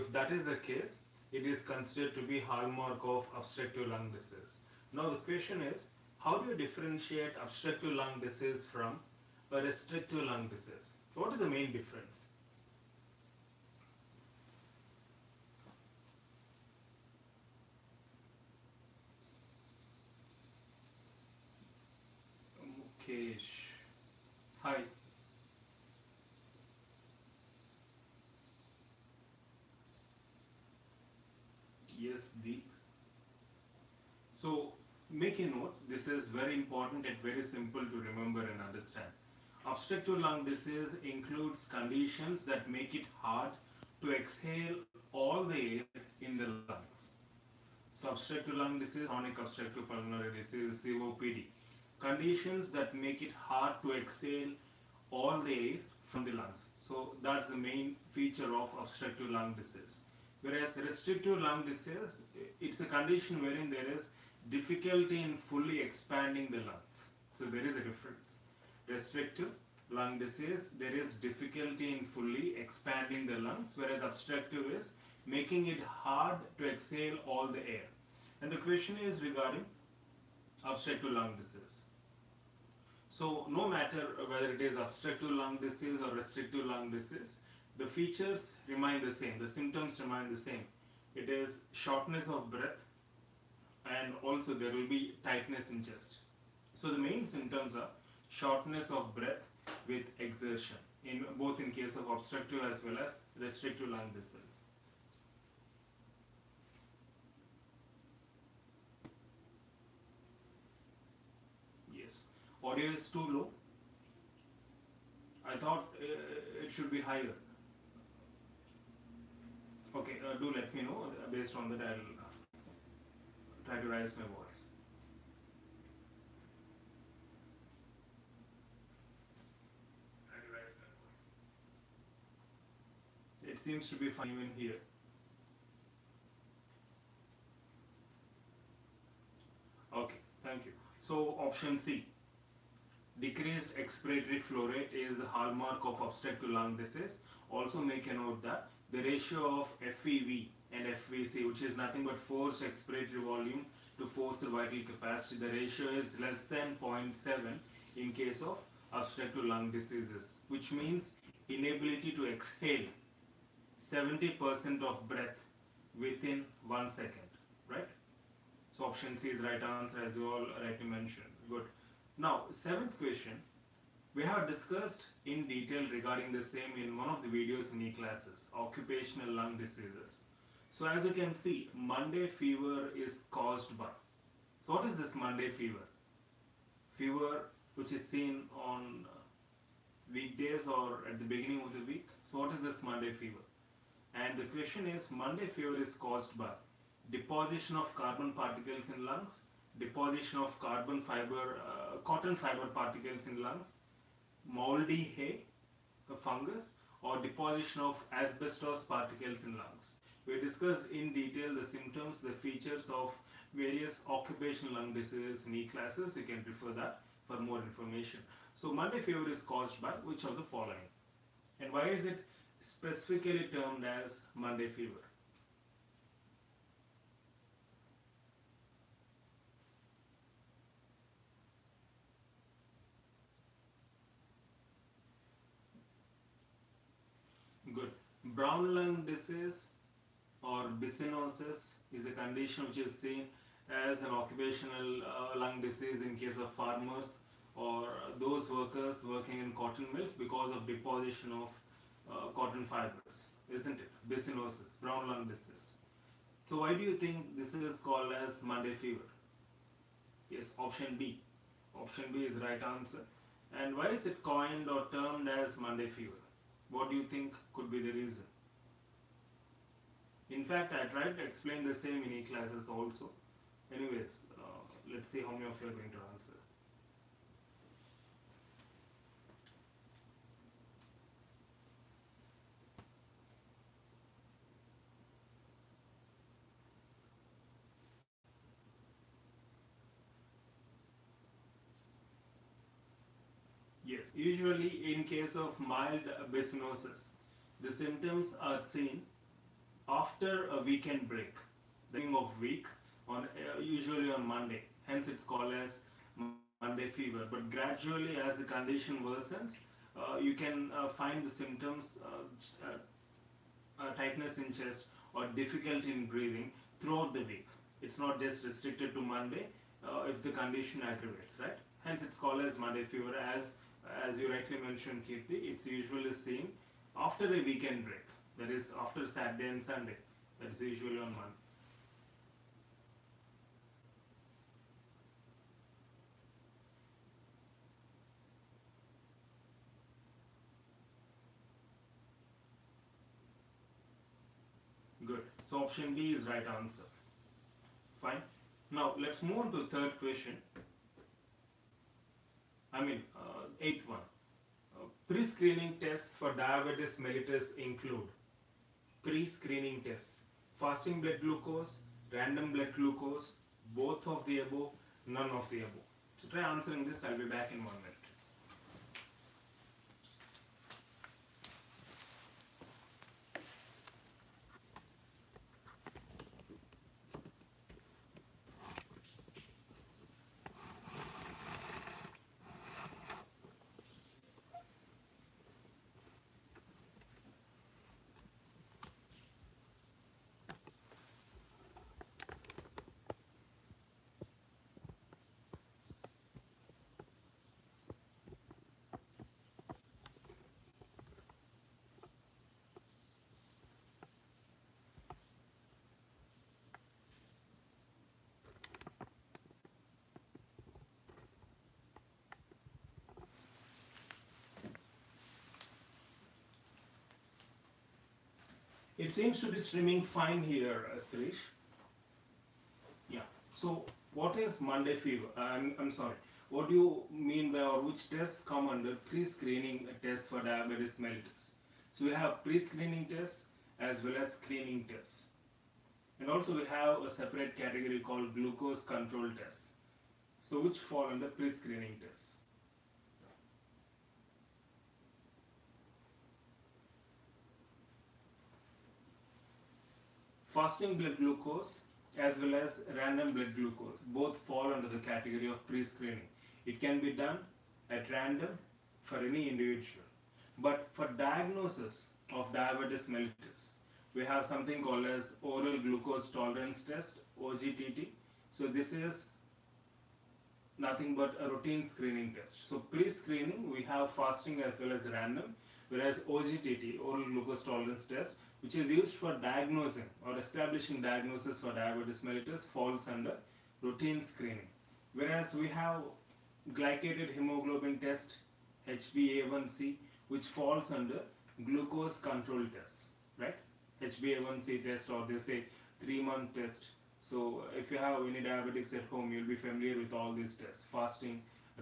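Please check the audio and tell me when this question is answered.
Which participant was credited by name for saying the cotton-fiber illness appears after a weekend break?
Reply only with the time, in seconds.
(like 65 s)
325 s.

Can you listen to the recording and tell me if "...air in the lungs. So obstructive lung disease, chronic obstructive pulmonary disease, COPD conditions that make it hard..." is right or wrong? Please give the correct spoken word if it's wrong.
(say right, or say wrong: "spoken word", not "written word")
right.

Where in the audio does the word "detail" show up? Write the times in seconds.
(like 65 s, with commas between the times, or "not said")
175 s, 211 s.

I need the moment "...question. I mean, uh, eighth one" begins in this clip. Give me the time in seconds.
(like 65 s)
349 s.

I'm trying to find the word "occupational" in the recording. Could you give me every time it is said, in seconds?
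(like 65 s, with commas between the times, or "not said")
178 s, 214 s, 244 s.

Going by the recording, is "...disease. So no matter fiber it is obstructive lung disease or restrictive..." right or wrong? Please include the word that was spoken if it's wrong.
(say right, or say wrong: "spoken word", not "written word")
wrong: "whether", not "fiber".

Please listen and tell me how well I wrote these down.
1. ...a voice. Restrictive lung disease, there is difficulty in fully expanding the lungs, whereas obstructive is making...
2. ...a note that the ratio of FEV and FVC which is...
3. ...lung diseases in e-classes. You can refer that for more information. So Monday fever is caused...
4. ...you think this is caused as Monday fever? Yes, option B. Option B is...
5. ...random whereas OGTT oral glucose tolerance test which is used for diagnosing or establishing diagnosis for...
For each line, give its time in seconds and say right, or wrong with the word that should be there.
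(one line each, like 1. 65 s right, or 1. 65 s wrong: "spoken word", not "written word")
1. 67 s wrong: "difference", not "voice"
2. 148 s right
3. 214 s right
4. 256 s wrong: "called", not "caused"
5. 475 s right.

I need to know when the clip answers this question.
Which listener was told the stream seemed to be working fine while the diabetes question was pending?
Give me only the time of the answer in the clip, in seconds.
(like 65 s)
420 s.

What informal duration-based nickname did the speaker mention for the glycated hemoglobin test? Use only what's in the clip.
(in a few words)
three month test.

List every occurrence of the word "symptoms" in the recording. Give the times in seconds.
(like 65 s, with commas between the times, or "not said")
89 s, 97 s, 211 s, 297 s, 311 s.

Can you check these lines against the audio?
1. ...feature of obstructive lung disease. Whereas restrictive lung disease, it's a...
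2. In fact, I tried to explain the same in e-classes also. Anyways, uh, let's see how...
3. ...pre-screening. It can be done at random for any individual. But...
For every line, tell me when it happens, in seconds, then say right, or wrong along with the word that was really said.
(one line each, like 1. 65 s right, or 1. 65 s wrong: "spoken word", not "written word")
1. 58 s right
2. 270 s right
3. 455 s right.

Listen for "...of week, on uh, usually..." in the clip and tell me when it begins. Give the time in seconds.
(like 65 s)
302 s.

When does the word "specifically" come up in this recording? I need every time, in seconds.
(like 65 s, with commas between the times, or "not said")
222 s.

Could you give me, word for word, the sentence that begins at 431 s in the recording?
So we have pre-screening tests as well as screening tests.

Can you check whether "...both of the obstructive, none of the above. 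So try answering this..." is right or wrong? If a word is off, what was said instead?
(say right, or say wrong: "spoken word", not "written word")
wrong: "above", not "obstructive".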